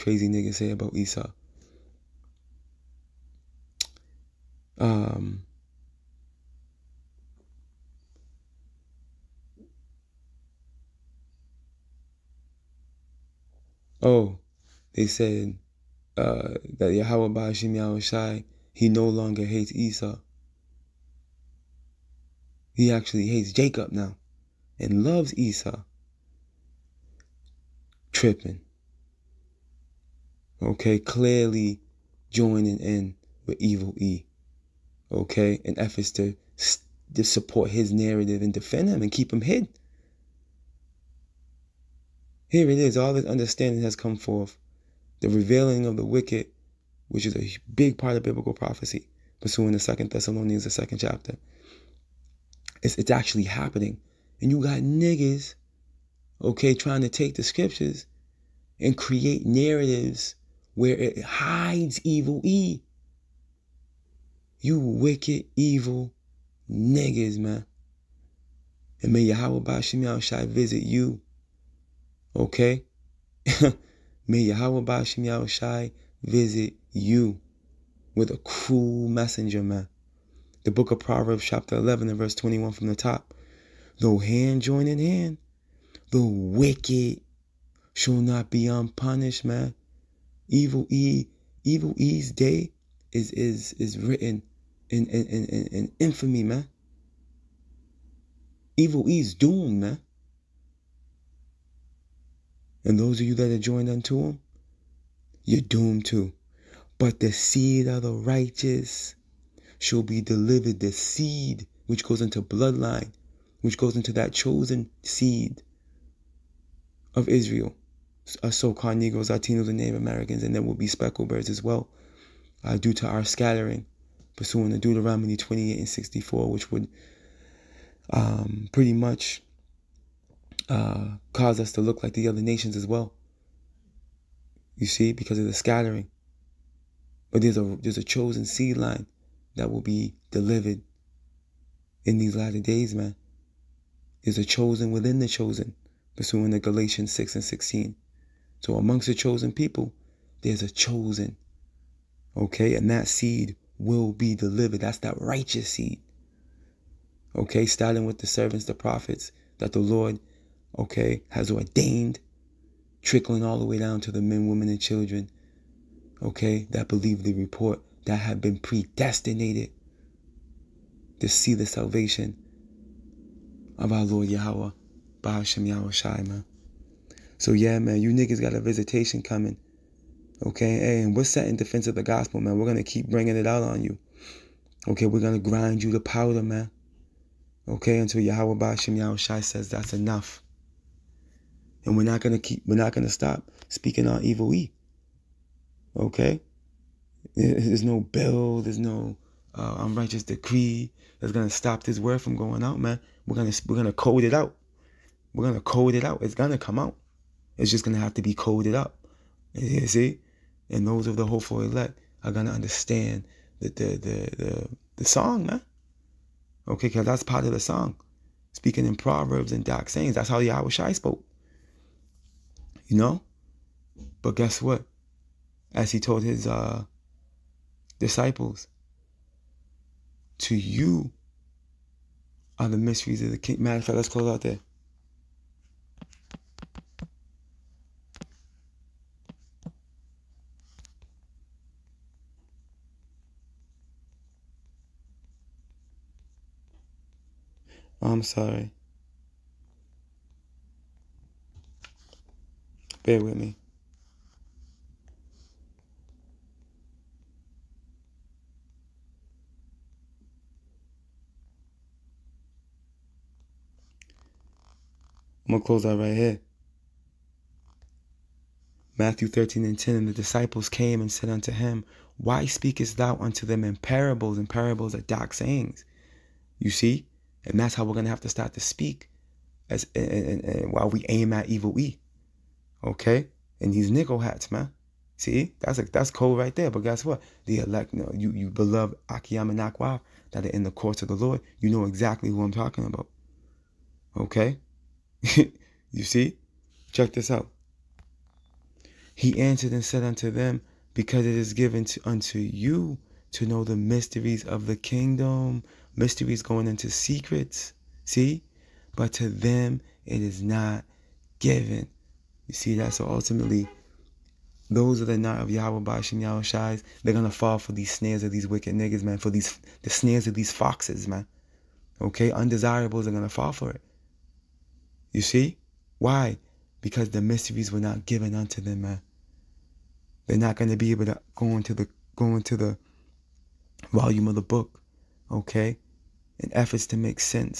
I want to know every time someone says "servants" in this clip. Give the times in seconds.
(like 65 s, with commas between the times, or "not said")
158 s.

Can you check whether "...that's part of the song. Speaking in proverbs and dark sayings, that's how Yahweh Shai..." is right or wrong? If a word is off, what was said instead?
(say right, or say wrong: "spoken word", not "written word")
right.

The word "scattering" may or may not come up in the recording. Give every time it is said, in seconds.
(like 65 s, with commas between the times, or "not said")
123 s, 135 s.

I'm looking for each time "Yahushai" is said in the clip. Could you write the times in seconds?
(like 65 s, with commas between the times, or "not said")
70 s, 75 s.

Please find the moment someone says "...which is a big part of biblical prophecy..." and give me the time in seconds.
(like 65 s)
47 s.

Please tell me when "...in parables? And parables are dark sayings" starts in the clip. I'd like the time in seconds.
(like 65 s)
273 s.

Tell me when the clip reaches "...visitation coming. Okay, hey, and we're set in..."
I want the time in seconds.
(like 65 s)
178 s.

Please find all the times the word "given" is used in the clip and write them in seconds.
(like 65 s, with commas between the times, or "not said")
301 s, 311 s, 328 s.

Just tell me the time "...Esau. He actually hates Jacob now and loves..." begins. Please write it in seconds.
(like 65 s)
19 s.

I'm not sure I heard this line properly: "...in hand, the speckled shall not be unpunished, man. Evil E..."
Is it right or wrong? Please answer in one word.
wrong.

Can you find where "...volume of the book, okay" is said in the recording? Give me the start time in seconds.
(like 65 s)
333 s.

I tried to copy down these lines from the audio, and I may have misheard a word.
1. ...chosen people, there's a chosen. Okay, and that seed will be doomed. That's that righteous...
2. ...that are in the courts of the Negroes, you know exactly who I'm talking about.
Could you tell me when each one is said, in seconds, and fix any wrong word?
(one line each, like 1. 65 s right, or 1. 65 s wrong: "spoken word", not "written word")
1. 149 s wrong: "delivered", not "doomed"
2. 289 s wrong: "Lord", not "Negroes".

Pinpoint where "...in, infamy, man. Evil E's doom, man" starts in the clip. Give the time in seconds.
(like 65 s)
95 s.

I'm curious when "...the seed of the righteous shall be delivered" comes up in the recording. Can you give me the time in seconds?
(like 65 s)
107 s.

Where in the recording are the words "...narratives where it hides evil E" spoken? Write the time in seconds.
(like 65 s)
59 s.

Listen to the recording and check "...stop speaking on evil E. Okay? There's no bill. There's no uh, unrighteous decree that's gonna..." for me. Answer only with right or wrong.
right.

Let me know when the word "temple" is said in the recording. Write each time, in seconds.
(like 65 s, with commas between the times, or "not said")
not said.